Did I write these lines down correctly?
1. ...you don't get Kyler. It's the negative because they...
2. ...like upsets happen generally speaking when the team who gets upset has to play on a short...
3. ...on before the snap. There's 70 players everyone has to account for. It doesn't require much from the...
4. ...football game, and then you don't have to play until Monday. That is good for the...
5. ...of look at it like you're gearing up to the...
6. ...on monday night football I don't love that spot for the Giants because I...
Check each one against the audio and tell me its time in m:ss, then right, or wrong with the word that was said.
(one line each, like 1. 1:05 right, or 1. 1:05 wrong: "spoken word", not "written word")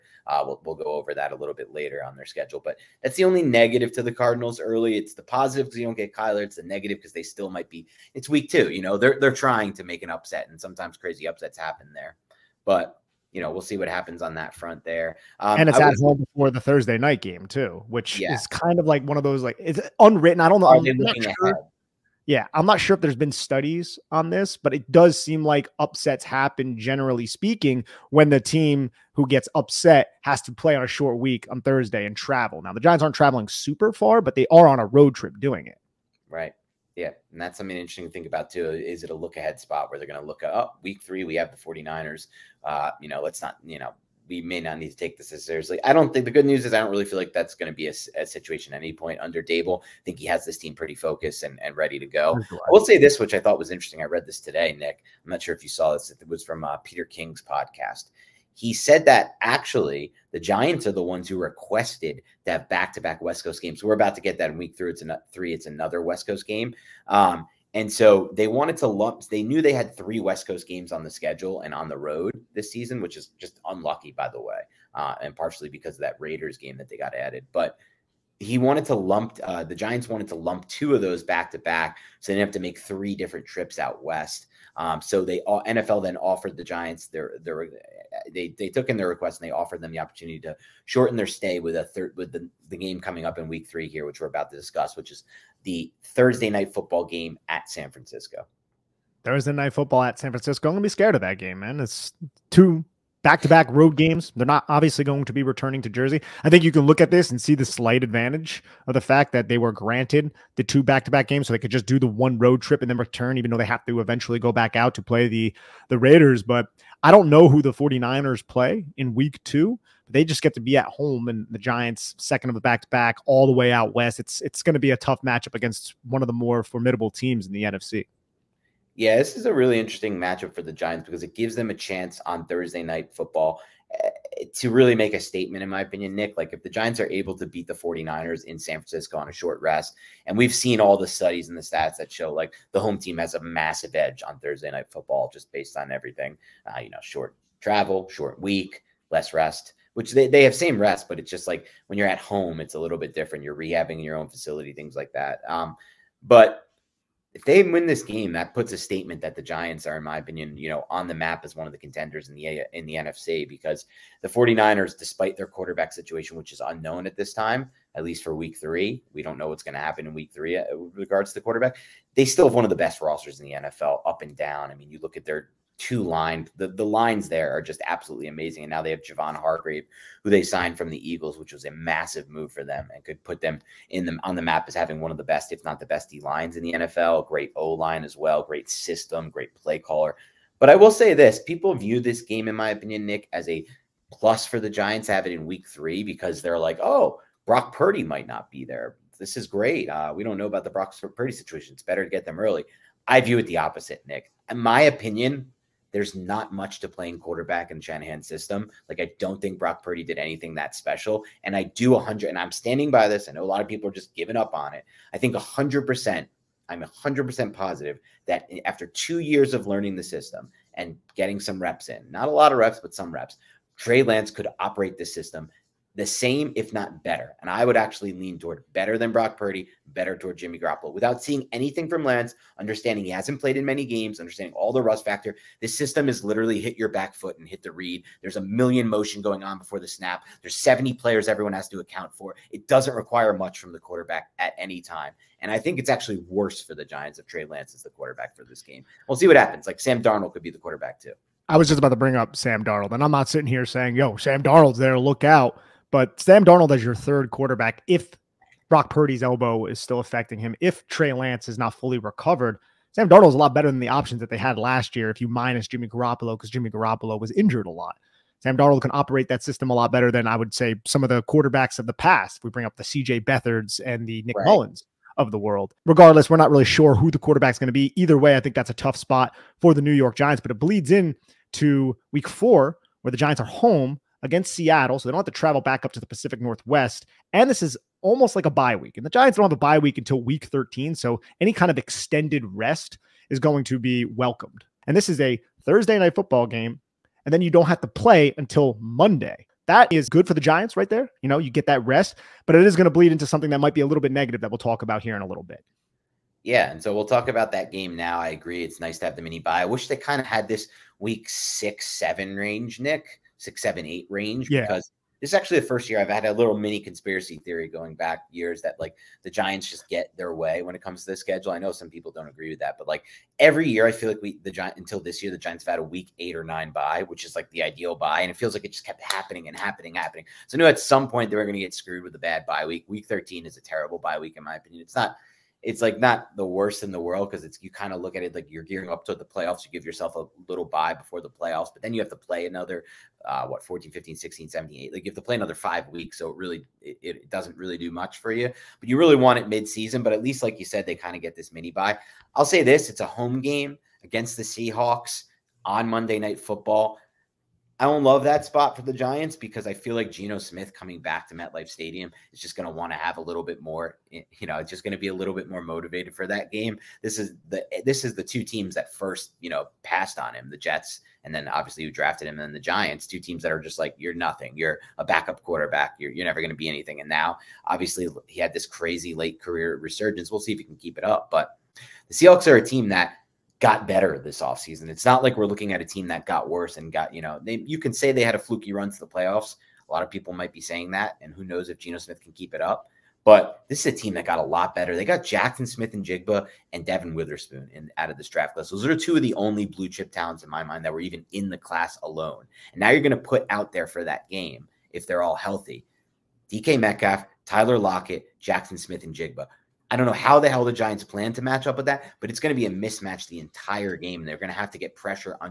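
1. 0:05 right
2. 0:25 right
3. 3:59 right
4. 4:56 right
5. 5:37 right
6. 5:55 right.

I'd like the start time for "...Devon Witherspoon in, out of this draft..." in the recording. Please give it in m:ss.
6:36.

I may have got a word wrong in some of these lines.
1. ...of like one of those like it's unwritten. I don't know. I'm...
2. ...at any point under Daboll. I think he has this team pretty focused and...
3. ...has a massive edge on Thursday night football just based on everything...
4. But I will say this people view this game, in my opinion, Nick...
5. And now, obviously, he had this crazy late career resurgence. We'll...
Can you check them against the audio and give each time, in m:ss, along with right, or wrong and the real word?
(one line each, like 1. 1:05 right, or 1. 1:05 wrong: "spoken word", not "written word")
1. 0:18 right
2. 0:48 right
3. 2:23 right
4. 3:10 right
5. 6:17 right.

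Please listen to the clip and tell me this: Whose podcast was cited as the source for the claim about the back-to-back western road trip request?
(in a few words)
Peter King.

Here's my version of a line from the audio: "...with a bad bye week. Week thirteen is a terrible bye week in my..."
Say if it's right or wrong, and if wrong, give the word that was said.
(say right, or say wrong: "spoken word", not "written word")
right.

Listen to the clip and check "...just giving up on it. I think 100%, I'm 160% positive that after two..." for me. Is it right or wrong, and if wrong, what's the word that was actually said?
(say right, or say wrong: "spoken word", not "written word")
wrong: "100", not "160".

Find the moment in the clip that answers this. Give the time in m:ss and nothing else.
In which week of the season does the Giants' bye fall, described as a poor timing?
4:50.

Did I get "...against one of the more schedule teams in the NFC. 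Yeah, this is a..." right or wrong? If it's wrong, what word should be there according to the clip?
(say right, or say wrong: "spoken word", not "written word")
wrong: "formidable", not "schedule".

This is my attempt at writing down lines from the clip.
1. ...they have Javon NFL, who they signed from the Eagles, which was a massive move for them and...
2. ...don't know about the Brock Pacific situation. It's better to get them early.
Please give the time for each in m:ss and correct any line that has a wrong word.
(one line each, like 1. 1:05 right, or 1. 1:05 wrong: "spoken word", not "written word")
1. 2:58 wrong: "Hargrave", not "NFL"
2. 3:20 wrong: "Purdy", not "Pacific".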